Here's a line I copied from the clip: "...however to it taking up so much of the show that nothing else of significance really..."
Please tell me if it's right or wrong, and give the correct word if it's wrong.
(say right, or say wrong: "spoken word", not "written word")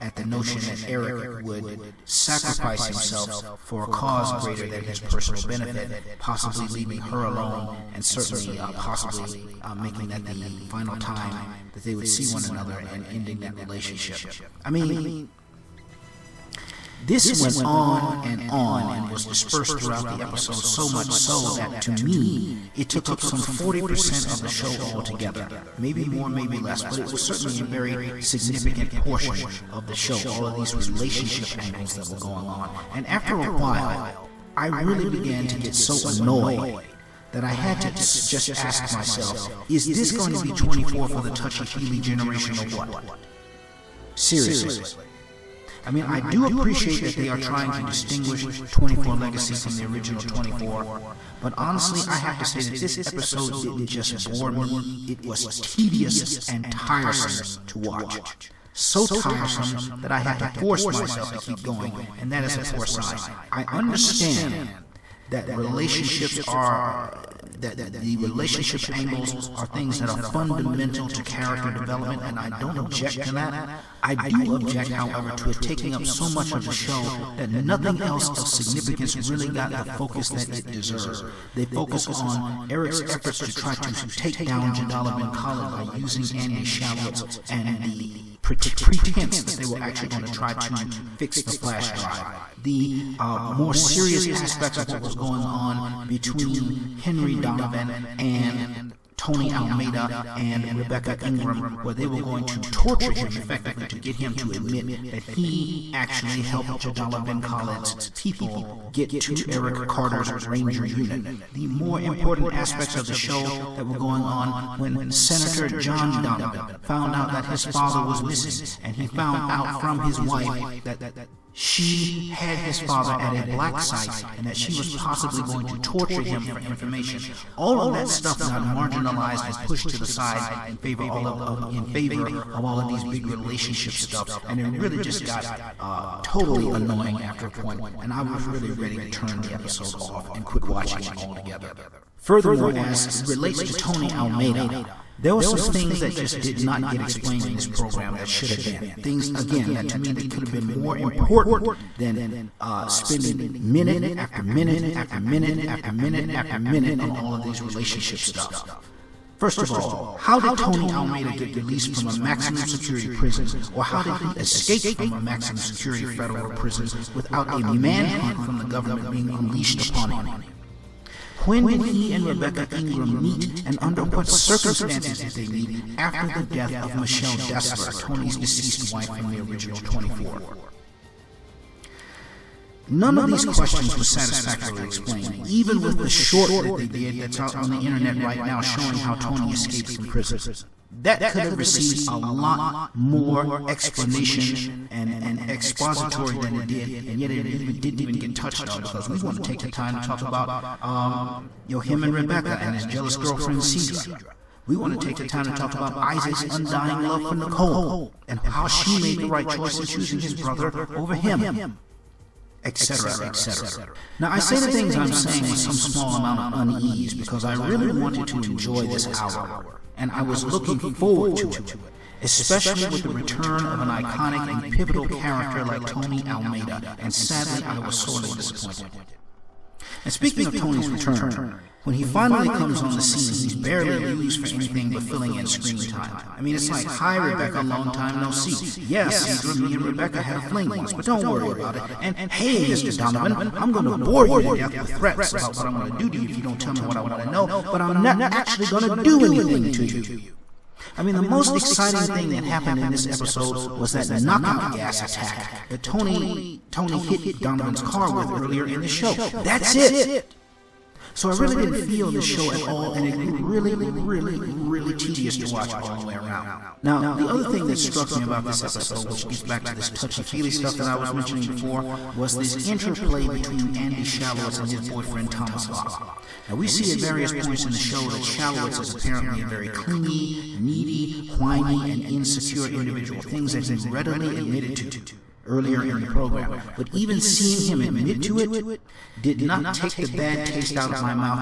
right.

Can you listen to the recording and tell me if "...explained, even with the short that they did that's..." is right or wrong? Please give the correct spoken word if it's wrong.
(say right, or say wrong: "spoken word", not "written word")
right.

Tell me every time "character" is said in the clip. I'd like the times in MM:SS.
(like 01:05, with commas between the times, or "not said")
01:11, 03:45.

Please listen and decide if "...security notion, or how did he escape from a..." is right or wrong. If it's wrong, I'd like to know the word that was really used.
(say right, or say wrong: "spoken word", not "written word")
wrong: "prison", not "notion".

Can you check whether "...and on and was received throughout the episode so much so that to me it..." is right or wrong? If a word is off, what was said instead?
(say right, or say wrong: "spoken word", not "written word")
wrong: "dispersed", not "received".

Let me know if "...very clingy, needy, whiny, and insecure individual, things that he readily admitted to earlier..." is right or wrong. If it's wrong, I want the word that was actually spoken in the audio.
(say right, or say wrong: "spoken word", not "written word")
right.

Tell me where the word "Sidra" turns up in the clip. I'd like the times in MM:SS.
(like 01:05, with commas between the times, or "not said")
03:23, 03:59.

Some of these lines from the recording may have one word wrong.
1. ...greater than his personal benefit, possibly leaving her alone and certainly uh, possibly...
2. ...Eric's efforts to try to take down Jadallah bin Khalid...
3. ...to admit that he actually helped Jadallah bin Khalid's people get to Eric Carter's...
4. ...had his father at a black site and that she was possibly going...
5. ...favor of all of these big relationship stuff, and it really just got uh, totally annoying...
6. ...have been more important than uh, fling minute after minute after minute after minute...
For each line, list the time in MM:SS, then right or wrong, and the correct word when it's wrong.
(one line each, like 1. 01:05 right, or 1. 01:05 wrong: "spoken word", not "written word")
1. 00:04 right
2. 01:22 right
3. 01:44 right
4. 02:02 right
5. 02:11 right
6. 02:30 wrong: "spending", not "fling".